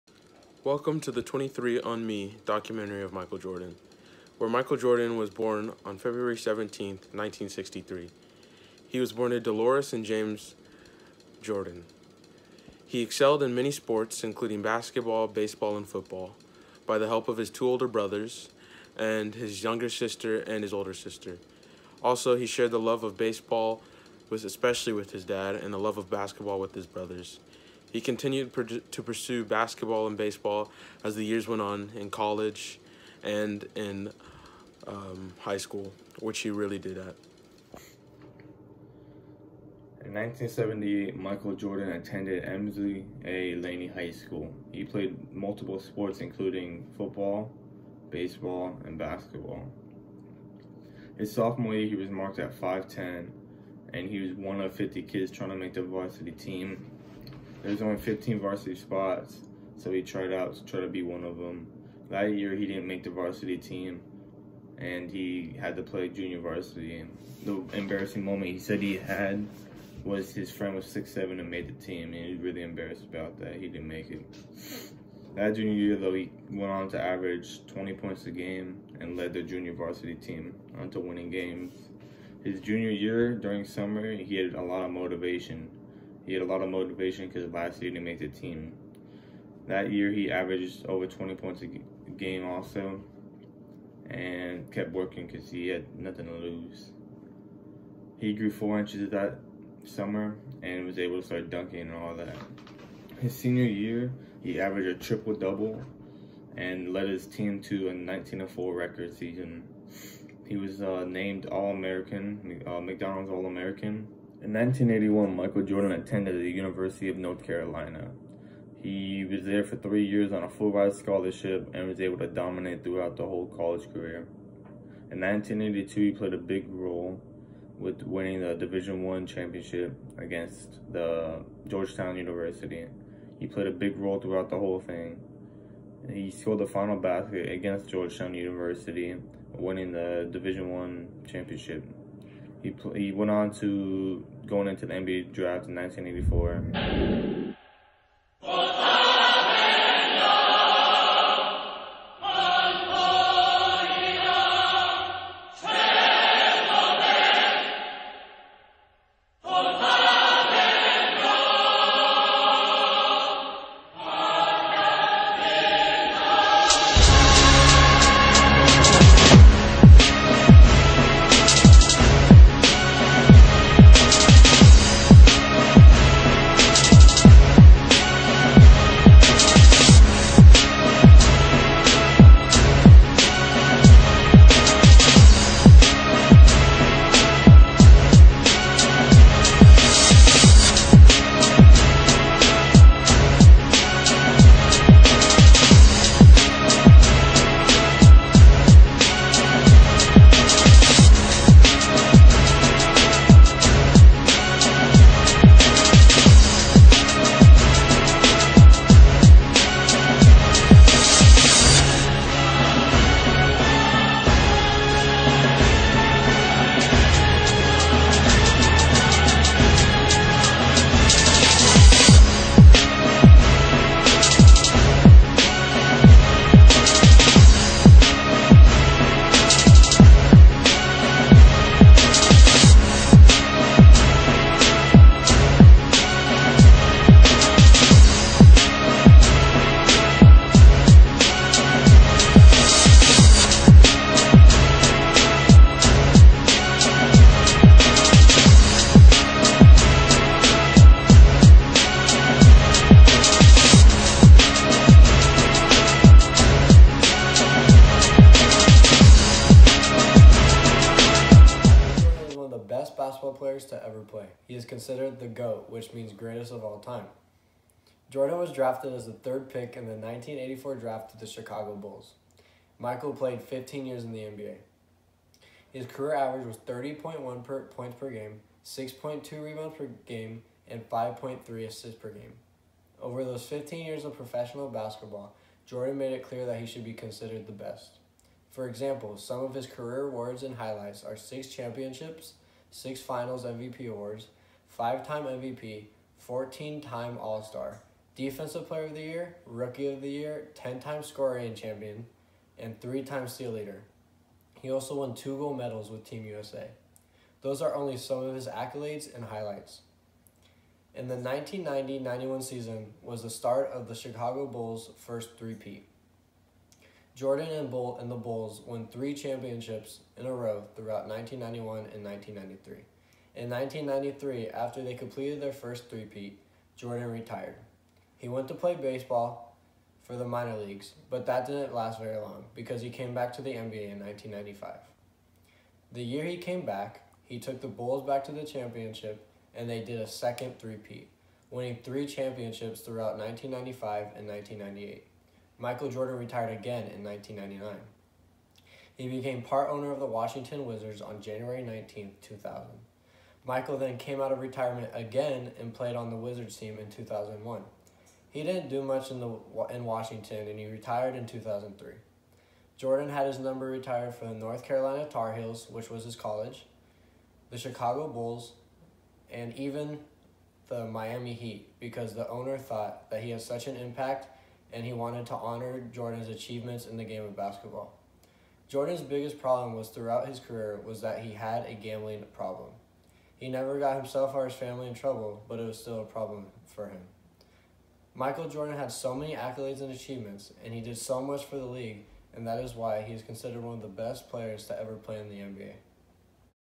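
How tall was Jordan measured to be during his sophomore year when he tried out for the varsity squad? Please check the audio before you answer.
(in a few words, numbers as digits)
5'10".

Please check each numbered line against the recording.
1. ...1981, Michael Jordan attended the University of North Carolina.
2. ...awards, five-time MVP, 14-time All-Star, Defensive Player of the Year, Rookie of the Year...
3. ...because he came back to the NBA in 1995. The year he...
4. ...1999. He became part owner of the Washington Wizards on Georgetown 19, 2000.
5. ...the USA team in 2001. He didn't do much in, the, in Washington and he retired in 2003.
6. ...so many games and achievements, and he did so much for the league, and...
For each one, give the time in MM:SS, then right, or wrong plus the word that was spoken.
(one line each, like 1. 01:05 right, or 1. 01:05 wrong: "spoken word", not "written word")
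1. 01:54 right
2. 04:53 right
3. 05:32 right
4. 05:47 wrong: "January", not "Georgetown"
5. 05:56 wrong: "Wizards", not "USA"
6. 06:28 wrong: "accolades", not "games".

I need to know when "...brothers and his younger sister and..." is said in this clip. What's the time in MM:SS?
00:17.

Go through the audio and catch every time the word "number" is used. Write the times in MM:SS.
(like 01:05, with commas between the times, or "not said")
06:03.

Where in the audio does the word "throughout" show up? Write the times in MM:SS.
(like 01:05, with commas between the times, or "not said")
02:02, 02:14, 05:20, 05:42, 06:19.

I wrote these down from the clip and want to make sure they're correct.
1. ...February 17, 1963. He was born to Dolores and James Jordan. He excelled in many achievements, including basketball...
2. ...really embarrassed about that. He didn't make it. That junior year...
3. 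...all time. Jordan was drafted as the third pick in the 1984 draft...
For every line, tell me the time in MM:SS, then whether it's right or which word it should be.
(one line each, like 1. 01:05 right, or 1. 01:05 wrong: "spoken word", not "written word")
1. 00:05 wrong: "sports", not "achievements"
2. 01:12 right
3. 04:26 right.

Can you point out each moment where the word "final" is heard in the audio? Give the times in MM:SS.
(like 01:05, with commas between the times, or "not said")
02:16, 04:53.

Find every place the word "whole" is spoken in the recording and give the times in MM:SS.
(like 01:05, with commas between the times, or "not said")
02:03, 02:14.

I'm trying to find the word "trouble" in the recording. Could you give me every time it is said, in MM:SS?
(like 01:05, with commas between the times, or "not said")
06:24.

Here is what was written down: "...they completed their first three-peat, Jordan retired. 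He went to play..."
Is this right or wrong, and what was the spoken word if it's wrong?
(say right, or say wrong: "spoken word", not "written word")
right.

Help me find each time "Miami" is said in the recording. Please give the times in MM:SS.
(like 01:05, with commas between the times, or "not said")
06:10.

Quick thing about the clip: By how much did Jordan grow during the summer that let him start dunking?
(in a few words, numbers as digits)
four inches.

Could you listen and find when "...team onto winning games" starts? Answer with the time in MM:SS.
01:20.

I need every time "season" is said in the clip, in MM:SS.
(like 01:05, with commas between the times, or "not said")
01:49, 05:12.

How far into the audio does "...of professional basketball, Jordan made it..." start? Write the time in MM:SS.
04:44.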